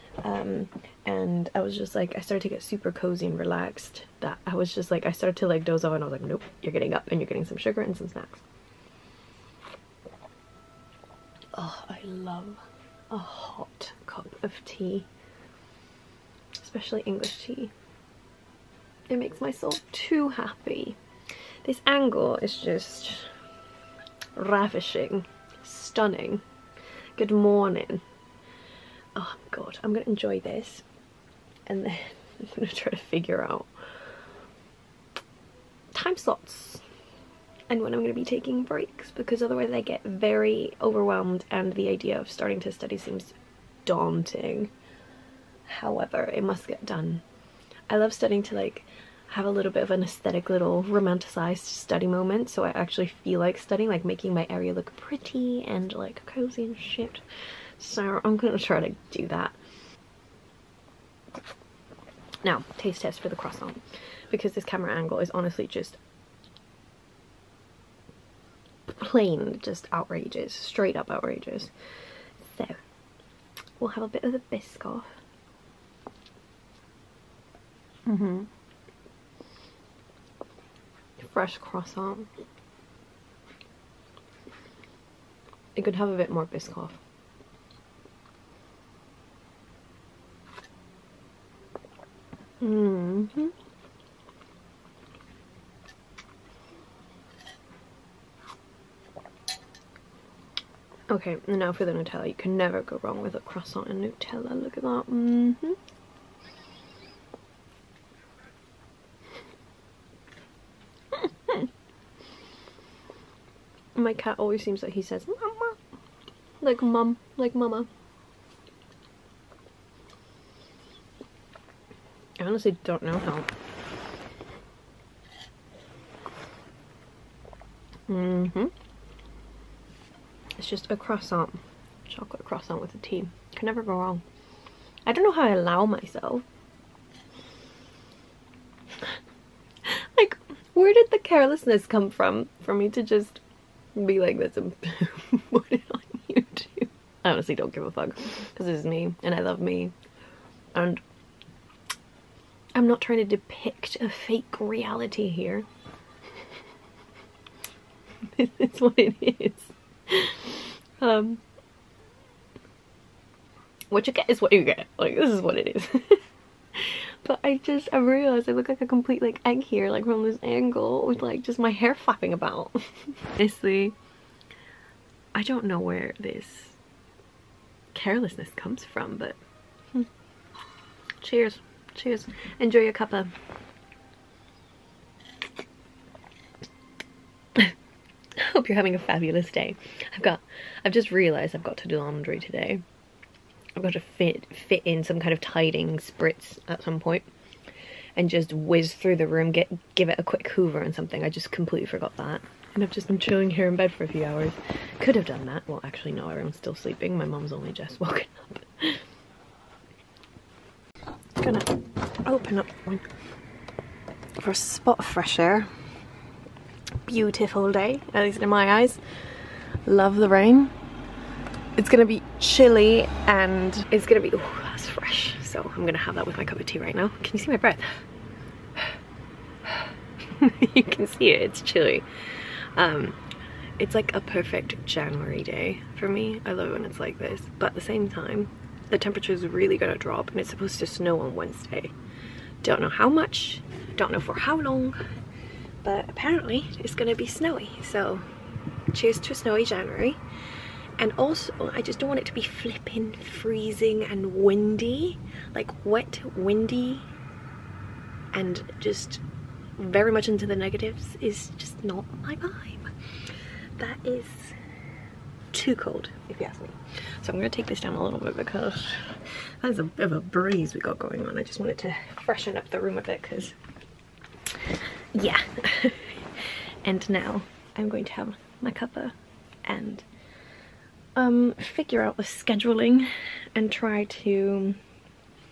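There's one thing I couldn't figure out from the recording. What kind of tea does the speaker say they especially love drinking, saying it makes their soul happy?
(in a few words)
English tea.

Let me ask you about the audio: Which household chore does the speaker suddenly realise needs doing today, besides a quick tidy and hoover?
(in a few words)
laundry.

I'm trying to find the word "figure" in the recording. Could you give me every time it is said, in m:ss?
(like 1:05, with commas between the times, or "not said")
0:32, 4:41.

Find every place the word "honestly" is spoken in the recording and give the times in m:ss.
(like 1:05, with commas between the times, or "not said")
1:05, 2:02, 2:27, 2:53.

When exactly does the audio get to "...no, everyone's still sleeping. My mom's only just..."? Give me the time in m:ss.
3:26.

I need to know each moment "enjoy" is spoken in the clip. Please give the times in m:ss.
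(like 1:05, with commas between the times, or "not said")
0:30, 3:02.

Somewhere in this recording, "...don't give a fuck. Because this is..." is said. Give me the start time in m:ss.
2:27.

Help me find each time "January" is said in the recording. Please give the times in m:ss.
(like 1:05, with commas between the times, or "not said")
3:54, 4:09.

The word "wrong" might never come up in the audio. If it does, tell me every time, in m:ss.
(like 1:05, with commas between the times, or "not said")
1:43, 2:13.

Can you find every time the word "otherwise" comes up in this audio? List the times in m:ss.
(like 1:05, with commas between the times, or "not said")
0:39.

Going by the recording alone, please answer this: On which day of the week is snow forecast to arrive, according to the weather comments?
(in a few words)
Wednesday.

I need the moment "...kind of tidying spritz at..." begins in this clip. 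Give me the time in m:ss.
3:15.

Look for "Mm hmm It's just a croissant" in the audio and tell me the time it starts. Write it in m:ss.
2:08.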